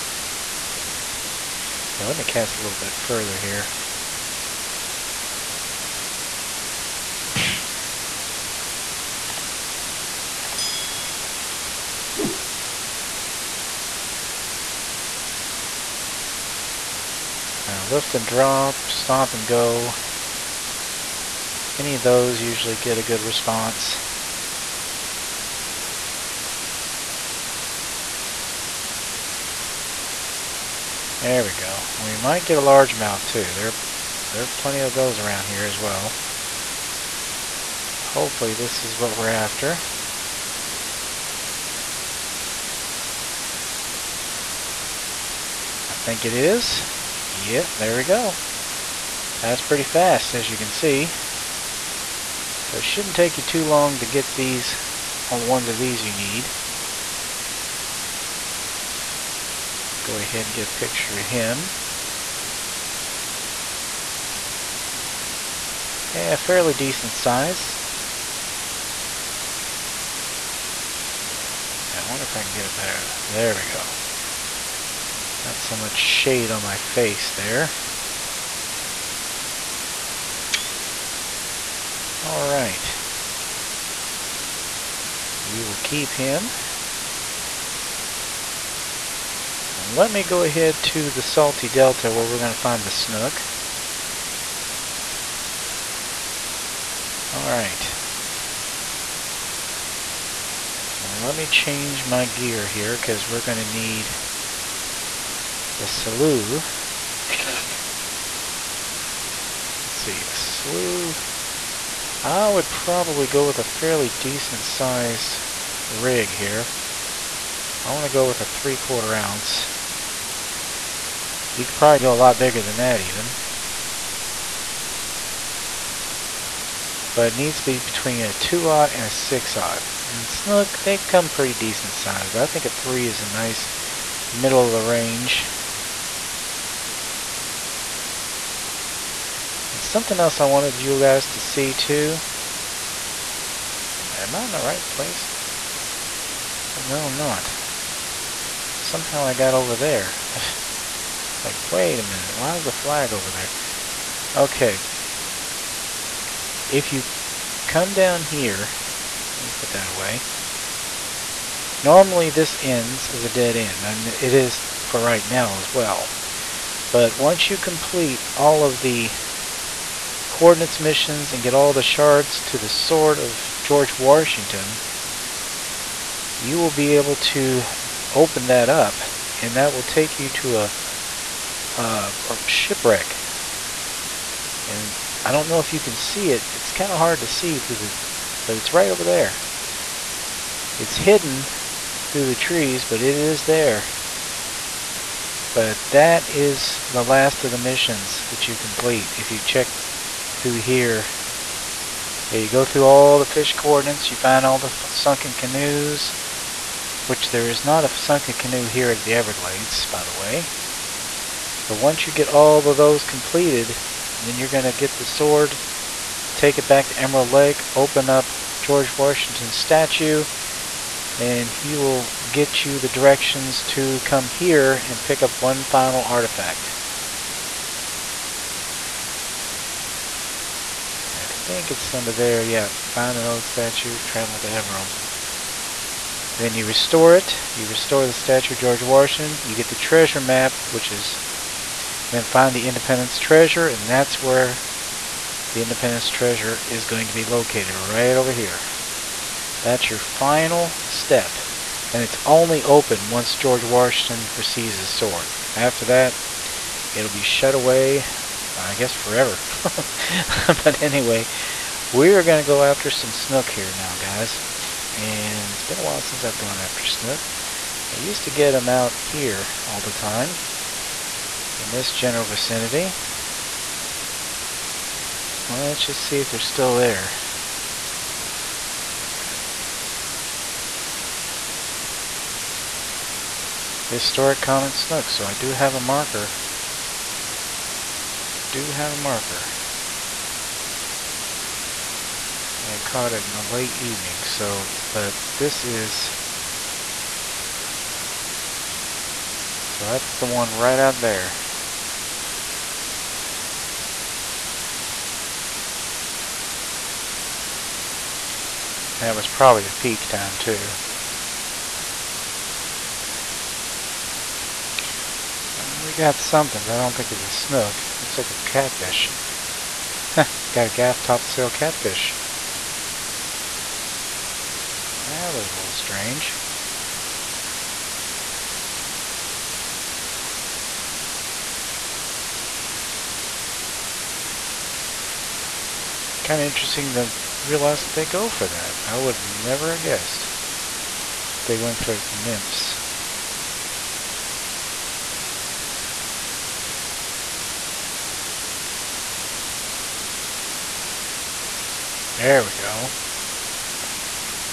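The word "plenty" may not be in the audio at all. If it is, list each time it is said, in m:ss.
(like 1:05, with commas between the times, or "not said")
0:34.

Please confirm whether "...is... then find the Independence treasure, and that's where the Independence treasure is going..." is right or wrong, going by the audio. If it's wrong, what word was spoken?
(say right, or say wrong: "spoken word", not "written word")
right.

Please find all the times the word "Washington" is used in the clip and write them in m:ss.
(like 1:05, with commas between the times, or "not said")
2:53, 3:38, 3:58, 4:13.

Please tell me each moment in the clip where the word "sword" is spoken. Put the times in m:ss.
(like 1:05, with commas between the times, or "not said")
2:52, 3:35, 4:14.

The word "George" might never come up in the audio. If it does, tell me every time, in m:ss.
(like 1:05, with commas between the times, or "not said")
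2:53, 3:38, 3:58, 4:13.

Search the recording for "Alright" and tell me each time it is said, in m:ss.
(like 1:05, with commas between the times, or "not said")
1:22, 1:37.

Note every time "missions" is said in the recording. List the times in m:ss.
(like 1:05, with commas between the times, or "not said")
2:50, 3:17.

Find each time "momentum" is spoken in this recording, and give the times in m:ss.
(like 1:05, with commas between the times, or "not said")
not said.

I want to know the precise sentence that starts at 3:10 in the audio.
It's hidden through the trees, but it is there.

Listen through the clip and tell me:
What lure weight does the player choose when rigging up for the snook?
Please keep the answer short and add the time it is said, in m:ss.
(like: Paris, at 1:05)
3/4 ounce, at 1:58.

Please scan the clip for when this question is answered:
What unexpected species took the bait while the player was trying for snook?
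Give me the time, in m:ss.
5:20.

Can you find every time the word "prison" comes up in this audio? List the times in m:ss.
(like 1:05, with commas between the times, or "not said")
not said.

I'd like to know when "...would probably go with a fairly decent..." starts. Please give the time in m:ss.
1:52.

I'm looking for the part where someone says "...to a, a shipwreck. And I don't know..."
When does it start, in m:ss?
3:00.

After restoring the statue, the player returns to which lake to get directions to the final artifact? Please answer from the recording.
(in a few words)
Emerald Lake.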